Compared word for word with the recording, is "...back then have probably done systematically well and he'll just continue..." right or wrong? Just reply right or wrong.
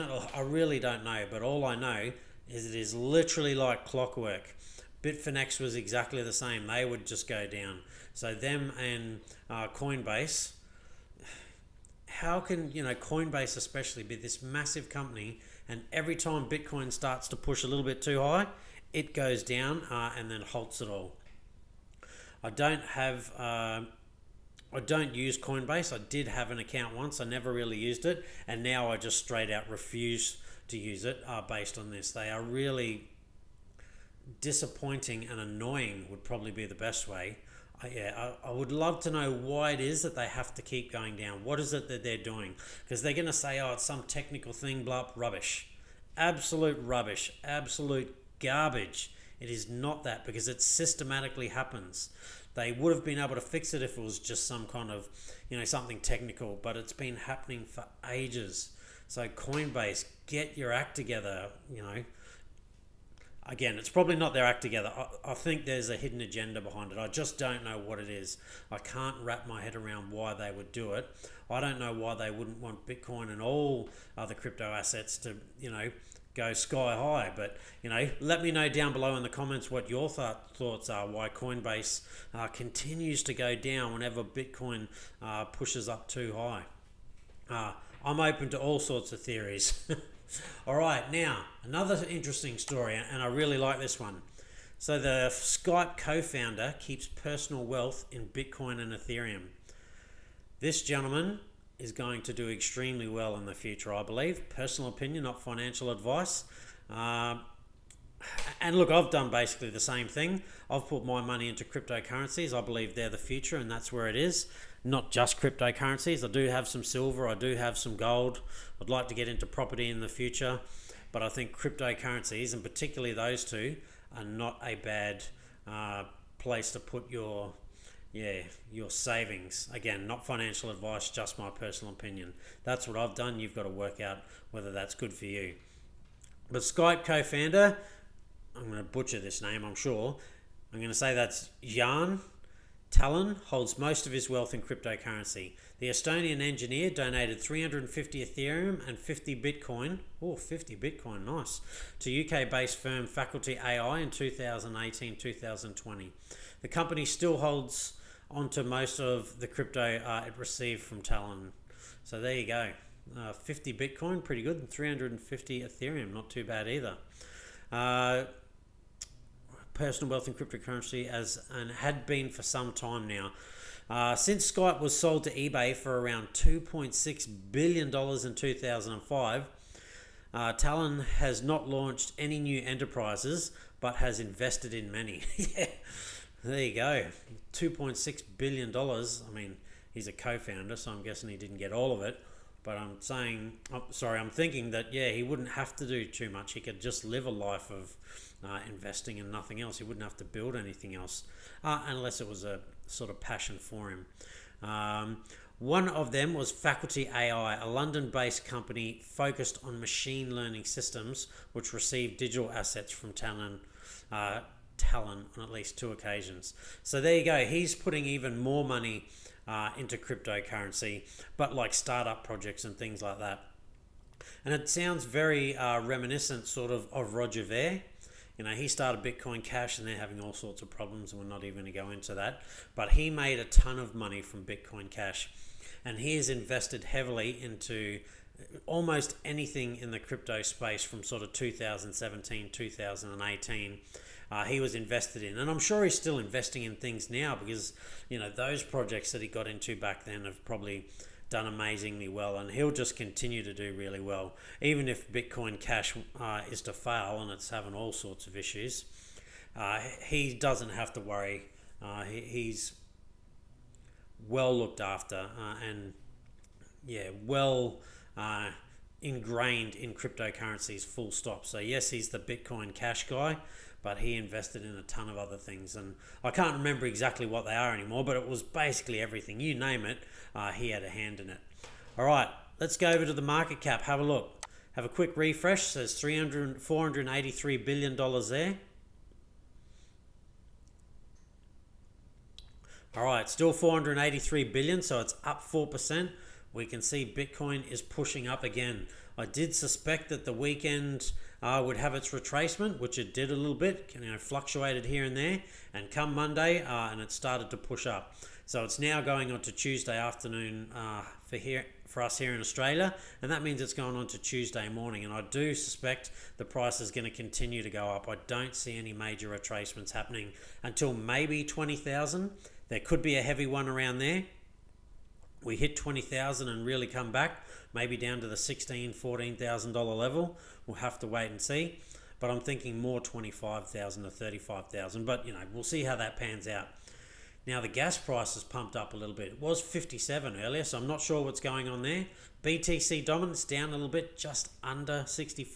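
wrong.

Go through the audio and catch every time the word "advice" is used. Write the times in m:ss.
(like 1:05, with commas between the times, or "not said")
1:45, 2:10.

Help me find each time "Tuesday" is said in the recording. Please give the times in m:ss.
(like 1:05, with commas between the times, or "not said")
5:09, 5:14.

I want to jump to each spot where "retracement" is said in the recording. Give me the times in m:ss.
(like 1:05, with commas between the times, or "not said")
5:02, 5:19.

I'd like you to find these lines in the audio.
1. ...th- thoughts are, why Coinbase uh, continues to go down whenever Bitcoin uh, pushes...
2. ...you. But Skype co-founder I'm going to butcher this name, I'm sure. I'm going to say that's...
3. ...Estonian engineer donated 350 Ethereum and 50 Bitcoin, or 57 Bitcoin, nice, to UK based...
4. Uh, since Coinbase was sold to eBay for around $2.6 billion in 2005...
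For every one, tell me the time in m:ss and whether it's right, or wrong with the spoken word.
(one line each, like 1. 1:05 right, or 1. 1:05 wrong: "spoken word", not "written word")
1. 1:20 right
2. 2:15 right
3. 2:25 wrong: "50", not "57"
4. 2:53 wrong: "Skype", not "Coinbase".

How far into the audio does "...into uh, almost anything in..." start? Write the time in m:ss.
3:57.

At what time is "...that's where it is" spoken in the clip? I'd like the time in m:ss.
1:53.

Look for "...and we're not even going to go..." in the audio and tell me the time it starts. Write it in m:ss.
3:51.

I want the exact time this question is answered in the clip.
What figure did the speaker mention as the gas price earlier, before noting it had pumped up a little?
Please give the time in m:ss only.
5:39.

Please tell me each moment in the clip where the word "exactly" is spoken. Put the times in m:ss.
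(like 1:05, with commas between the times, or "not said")
0:05, 4:36.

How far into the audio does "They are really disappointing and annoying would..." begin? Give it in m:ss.
0:32.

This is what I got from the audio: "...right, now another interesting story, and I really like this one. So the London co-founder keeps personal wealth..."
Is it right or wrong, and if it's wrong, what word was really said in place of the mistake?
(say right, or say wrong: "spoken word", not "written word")
wrong: "Skype", not "London".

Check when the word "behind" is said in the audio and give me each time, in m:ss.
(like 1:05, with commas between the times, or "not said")
1:06.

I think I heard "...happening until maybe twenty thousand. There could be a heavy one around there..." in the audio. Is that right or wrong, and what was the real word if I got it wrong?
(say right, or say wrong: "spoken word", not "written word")
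right.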